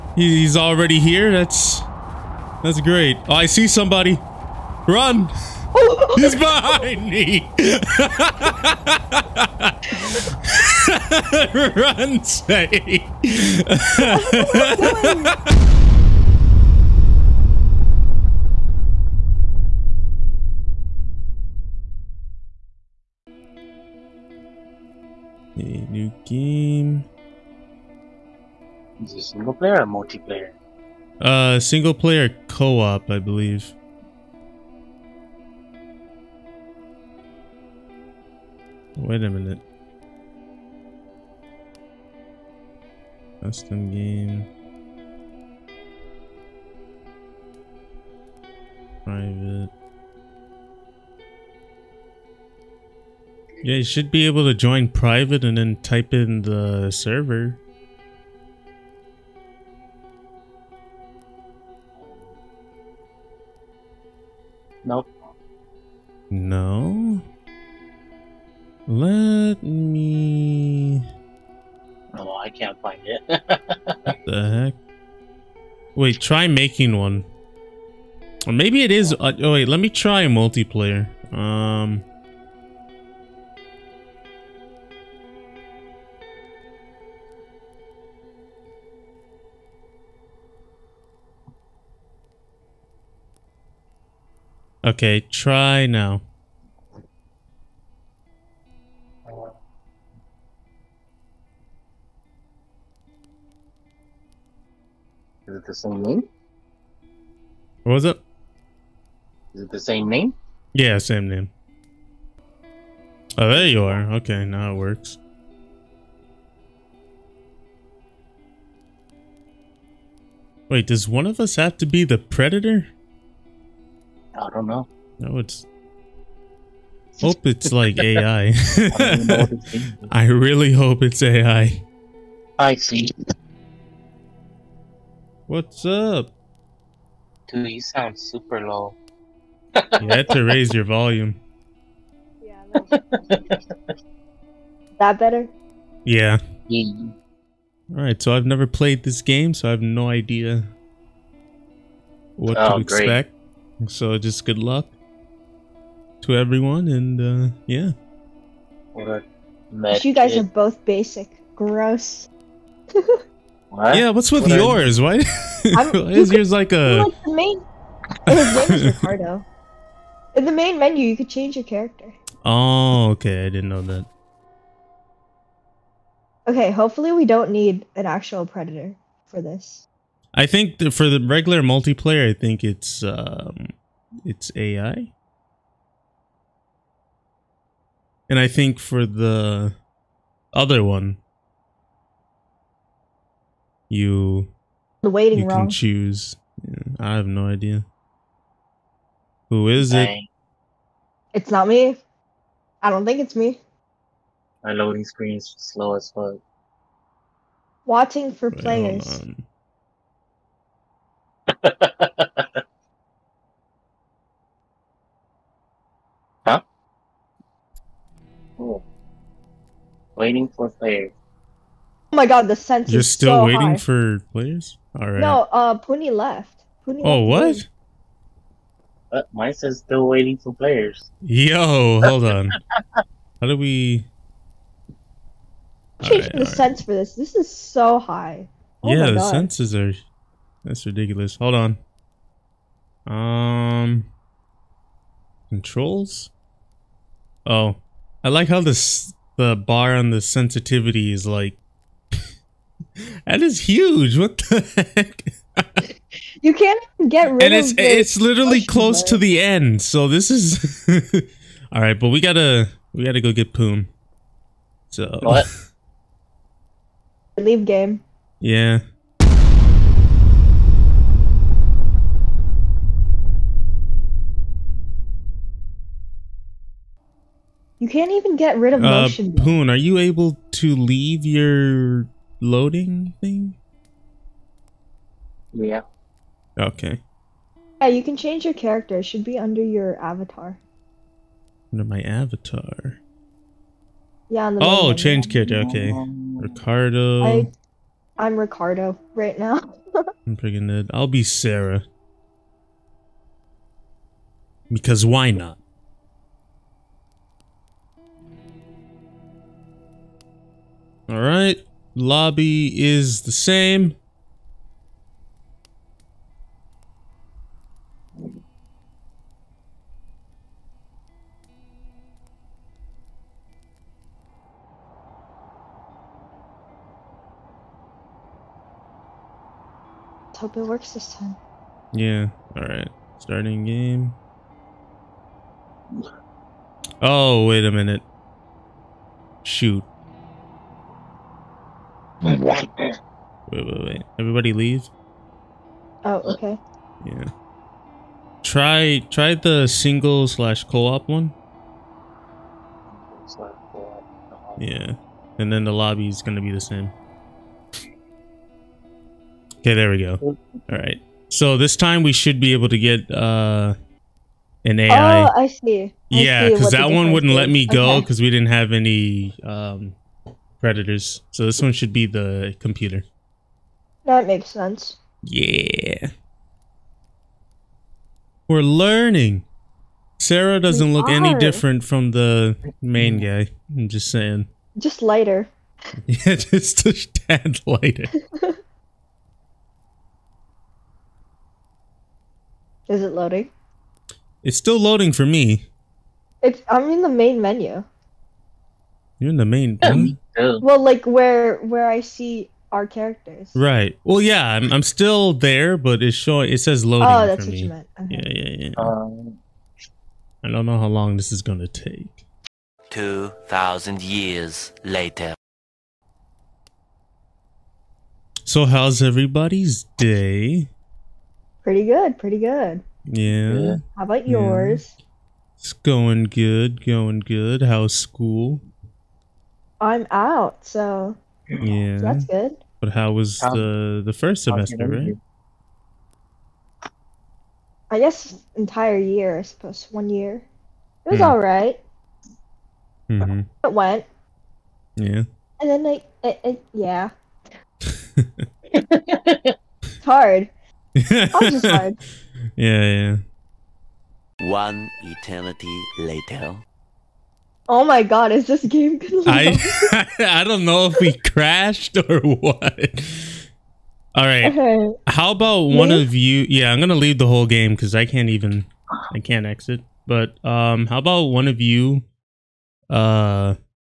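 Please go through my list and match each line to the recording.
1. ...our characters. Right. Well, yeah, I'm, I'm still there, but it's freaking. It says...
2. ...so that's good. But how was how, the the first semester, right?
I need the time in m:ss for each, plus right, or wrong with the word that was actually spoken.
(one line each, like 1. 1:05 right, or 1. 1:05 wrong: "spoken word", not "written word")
1. 6:42 wrong: "showing", not "freaking"
2. 7:11 right.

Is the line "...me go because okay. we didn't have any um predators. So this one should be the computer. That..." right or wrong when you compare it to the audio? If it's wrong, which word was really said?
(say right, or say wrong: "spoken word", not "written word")
right.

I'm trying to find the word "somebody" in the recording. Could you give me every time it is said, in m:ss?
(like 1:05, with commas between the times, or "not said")
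0:03.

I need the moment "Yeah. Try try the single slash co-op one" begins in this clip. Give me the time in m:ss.
5:47.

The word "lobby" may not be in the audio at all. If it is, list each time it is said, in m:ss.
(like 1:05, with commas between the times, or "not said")
5:12, 5:55.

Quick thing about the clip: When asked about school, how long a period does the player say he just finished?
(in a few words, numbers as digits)
One year.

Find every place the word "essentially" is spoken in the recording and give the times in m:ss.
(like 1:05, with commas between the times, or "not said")
not said.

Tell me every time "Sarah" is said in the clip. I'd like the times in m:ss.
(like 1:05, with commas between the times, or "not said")
5:01, 6:20.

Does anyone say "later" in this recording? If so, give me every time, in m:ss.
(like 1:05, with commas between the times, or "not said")
6:54, 7:35.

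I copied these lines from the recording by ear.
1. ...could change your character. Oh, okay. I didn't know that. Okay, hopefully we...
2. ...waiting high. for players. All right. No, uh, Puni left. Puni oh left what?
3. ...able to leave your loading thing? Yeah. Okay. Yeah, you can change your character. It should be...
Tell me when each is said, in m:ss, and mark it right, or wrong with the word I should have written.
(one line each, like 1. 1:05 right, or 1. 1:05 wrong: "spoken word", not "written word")
1. 2:51 right
2. 3:43 right
3. 4:39 right.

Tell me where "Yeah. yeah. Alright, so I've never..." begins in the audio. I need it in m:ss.
2:26.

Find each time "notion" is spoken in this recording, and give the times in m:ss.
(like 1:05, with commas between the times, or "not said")
not said.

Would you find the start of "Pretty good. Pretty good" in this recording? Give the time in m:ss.
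7:01.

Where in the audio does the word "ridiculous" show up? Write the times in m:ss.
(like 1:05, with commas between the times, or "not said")
4:00.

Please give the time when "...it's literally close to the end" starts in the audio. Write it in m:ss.
4:17.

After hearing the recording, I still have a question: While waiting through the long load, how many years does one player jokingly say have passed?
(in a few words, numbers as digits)
2000.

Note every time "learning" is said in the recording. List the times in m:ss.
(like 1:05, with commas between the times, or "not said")
6:18.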